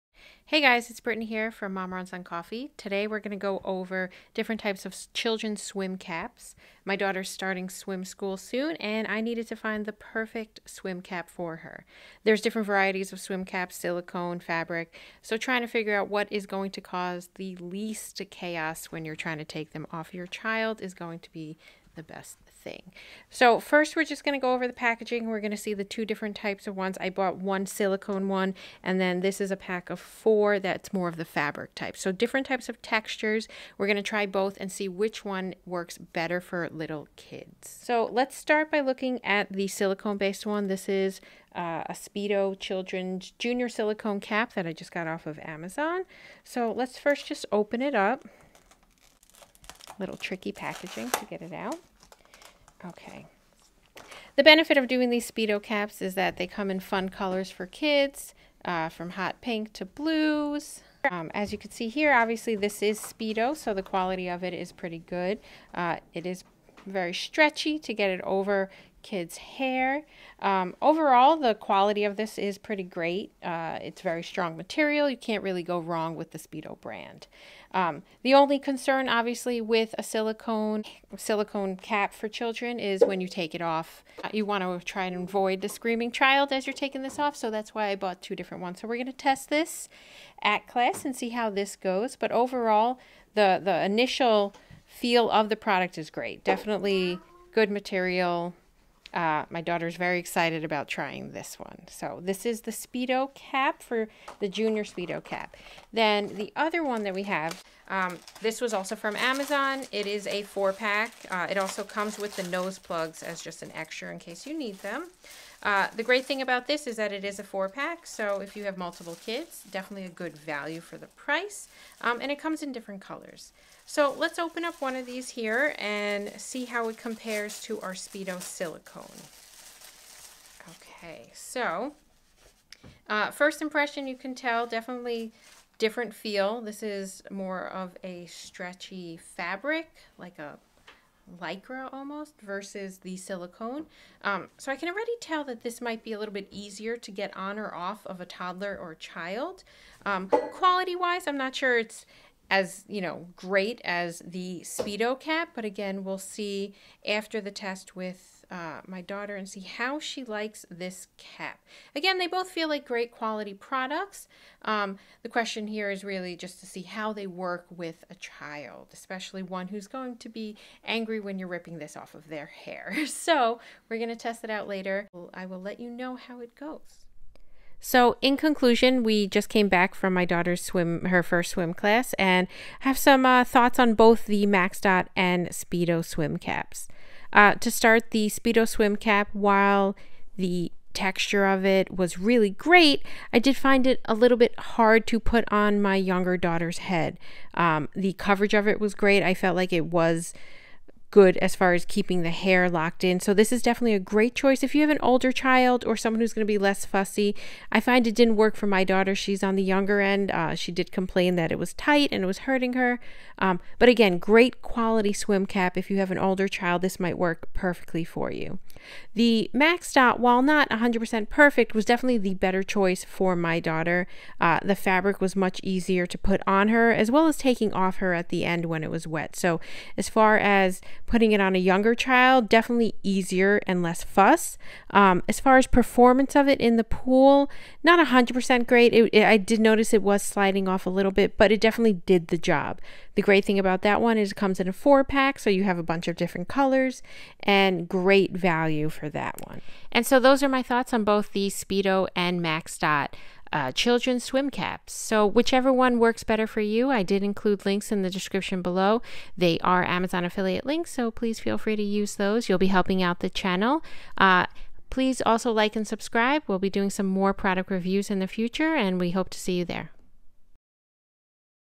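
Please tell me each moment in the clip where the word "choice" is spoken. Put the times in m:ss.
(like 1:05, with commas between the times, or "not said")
3:24, 3:42.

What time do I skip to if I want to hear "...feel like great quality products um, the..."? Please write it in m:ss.
2:42.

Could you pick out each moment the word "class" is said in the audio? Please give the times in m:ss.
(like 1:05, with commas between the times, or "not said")
1:30, 3:01.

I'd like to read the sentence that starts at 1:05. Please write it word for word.
Uh, it is very stretchy to get it over kids' hair.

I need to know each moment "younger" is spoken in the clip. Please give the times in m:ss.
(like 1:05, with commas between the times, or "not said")
3:15, 3:29, 3:51.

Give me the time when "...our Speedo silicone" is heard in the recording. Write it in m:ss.
2:07.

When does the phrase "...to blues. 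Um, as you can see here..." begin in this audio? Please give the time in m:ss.
0:59.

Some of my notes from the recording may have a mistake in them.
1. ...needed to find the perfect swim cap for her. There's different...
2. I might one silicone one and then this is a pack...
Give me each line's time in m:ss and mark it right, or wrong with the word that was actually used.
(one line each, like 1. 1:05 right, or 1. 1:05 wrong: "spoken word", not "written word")
1. 0:09 right
2. 0:27 wrong: "bought", not "might".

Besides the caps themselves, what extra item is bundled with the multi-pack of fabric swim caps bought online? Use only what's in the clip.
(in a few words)
Nose plugs.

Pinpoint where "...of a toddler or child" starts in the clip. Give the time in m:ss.
2:28.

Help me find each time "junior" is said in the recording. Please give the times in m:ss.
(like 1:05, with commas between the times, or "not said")
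0:43, 1:44.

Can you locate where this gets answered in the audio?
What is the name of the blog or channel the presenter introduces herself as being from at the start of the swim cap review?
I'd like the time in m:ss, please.
0:01.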